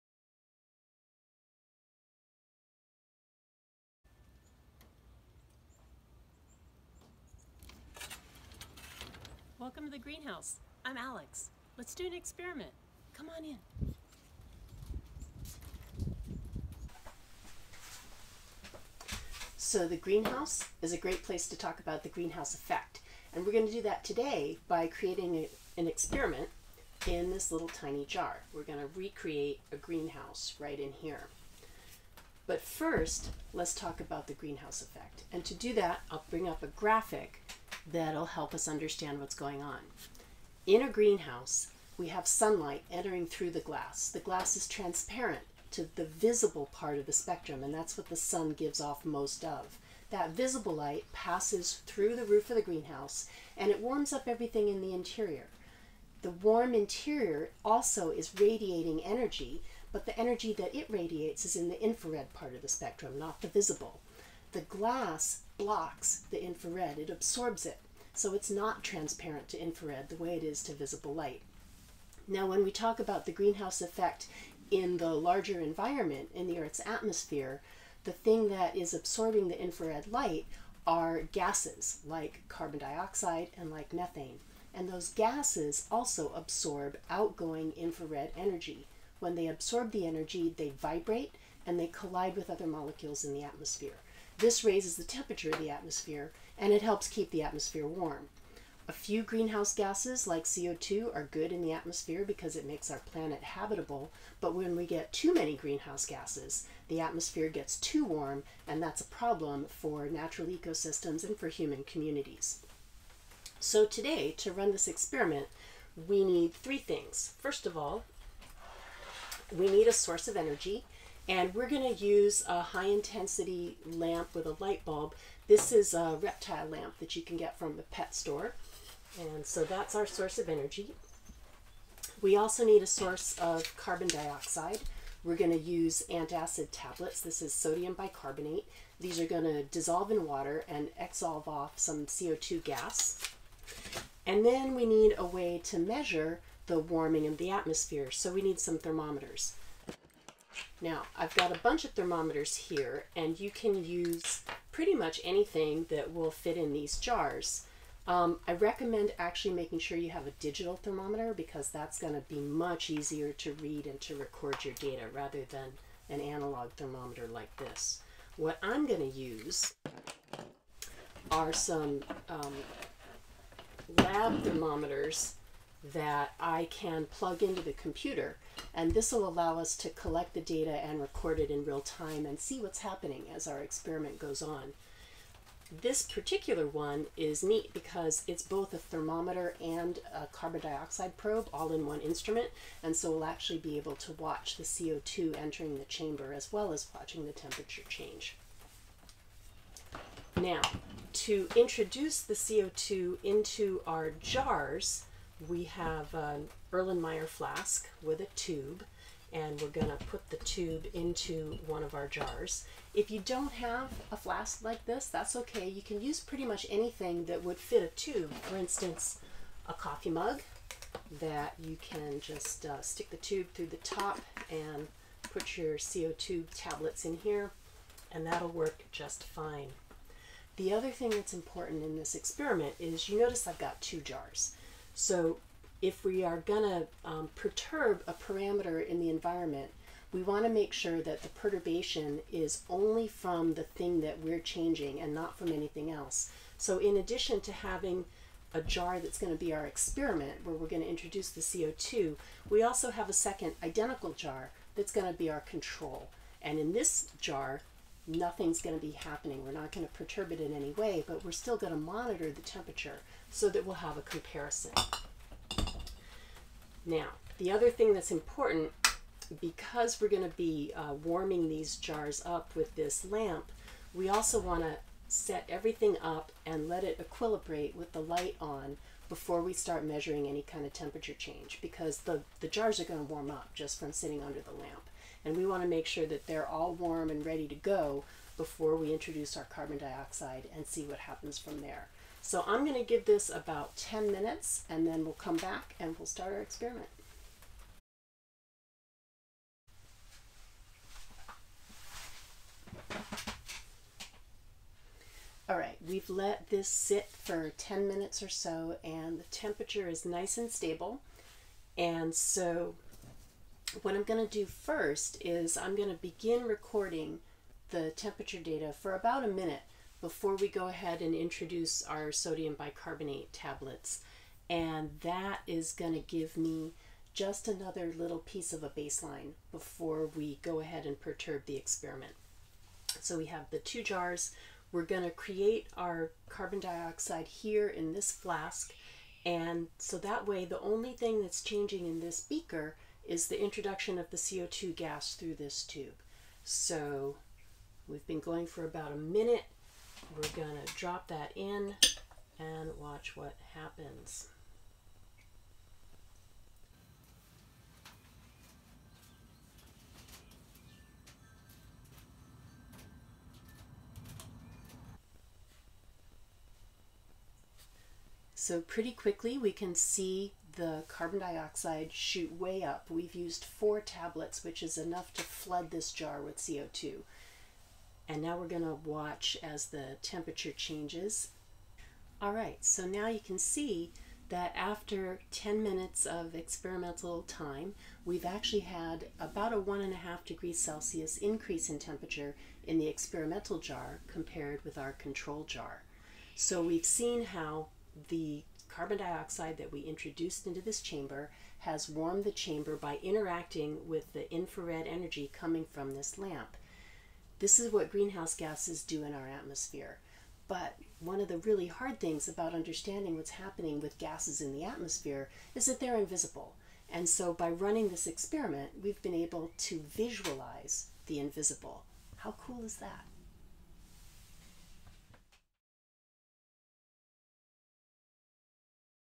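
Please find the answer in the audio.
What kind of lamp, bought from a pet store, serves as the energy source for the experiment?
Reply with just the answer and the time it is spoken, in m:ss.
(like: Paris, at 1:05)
reptile lamp, at 2:06.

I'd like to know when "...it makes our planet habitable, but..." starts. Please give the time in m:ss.
1:42.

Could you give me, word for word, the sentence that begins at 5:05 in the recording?
All right, we've let this sit for 10 minutes or so and the temperature is nice and stable.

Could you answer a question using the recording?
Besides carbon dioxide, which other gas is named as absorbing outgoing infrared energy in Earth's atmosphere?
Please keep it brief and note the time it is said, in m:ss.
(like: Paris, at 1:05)
methane, at 1:23.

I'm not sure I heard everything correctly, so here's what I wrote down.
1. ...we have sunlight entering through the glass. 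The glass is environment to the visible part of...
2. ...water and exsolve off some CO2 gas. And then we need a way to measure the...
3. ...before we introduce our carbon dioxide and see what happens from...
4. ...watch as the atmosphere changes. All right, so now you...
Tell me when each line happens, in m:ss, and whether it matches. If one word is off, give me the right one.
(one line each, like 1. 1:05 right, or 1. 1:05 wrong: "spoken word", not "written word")
1. 0:41 wrong: "transparent", not "environment"
2. 2:20 right
3. 4:48 right
4. 6:18 wrong: "temperature", not "atmosphere".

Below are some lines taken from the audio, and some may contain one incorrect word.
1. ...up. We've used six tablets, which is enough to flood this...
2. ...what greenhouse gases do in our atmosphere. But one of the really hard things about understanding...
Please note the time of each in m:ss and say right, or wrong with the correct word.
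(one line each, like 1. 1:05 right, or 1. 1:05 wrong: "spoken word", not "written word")
1. 6:12 wrong: "four", not "six"
2. 6:47 right.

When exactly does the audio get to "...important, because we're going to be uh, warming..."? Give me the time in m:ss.
4:28.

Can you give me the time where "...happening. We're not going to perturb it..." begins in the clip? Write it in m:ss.
4:18.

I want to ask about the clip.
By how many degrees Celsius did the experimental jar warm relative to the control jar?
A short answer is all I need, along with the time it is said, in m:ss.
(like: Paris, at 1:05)
1.5, at 6:29.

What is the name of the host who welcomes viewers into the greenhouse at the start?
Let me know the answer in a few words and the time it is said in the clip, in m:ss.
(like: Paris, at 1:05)
Alex, at 0:10.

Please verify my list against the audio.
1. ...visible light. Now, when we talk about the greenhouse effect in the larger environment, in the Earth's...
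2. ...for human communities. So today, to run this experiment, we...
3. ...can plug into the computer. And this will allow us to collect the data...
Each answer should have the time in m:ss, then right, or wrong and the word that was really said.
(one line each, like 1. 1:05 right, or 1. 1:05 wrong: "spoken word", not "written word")
1. 1:10 right
2. 1:51 right
3. 2:56 right.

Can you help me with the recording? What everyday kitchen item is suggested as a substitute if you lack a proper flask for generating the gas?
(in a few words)
coffee mug.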